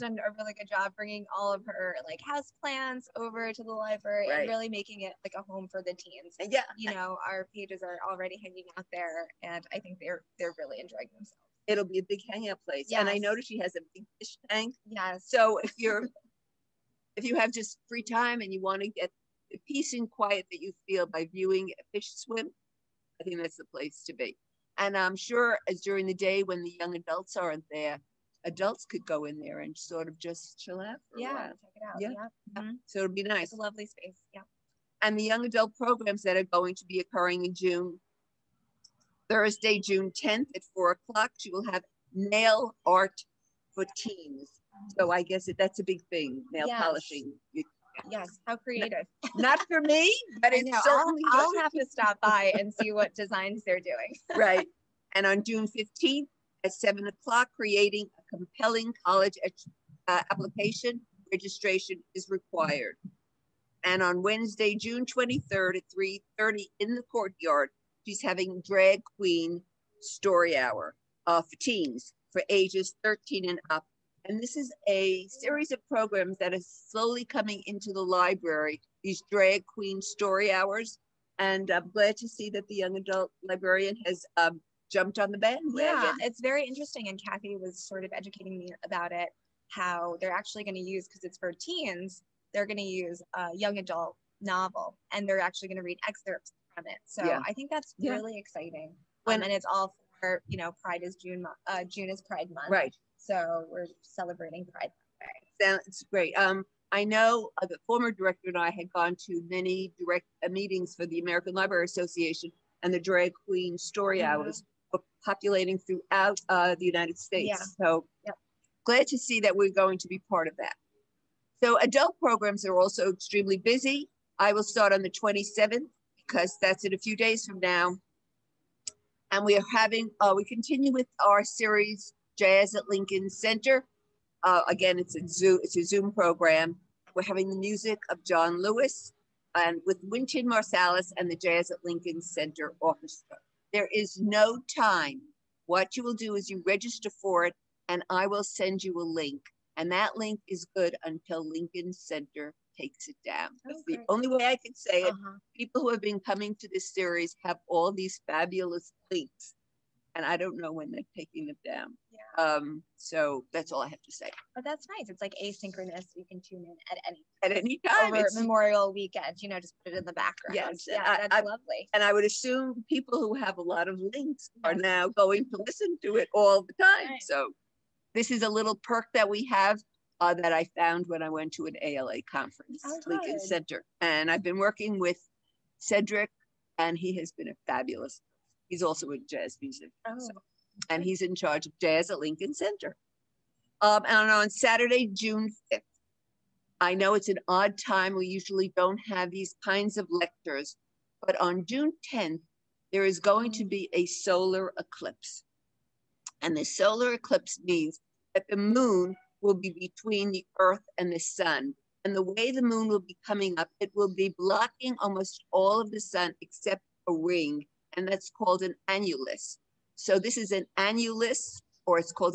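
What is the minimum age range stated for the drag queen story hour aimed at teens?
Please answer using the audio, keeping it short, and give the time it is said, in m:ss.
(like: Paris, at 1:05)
13 and up, at 1:13.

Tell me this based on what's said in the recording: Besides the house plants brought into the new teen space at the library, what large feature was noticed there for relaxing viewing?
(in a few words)
fish tank.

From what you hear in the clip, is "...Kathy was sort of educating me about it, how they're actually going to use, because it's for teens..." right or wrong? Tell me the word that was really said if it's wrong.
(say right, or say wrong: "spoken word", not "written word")
right.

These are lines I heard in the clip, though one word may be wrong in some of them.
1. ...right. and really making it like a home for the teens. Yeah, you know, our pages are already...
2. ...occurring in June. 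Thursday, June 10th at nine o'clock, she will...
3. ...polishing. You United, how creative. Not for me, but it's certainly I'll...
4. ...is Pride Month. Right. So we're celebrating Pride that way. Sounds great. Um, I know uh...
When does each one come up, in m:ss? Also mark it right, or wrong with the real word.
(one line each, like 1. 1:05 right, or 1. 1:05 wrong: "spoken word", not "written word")
1. 0:04 right
2. 0:36 wrong: "four", not "nine"
3. 0:46 wrong: "Yes", not "United"
4. 1:42 right.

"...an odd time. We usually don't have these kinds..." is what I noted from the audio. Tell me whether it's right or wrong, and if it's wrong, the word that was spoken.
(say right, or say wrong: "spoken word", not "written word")
right.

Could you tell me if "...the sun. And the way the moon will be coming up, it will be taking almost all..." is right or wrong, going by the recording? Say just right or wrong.
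wrong.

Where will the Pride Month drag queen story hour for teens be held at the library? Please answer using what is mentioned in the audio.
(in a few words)
the courtyard.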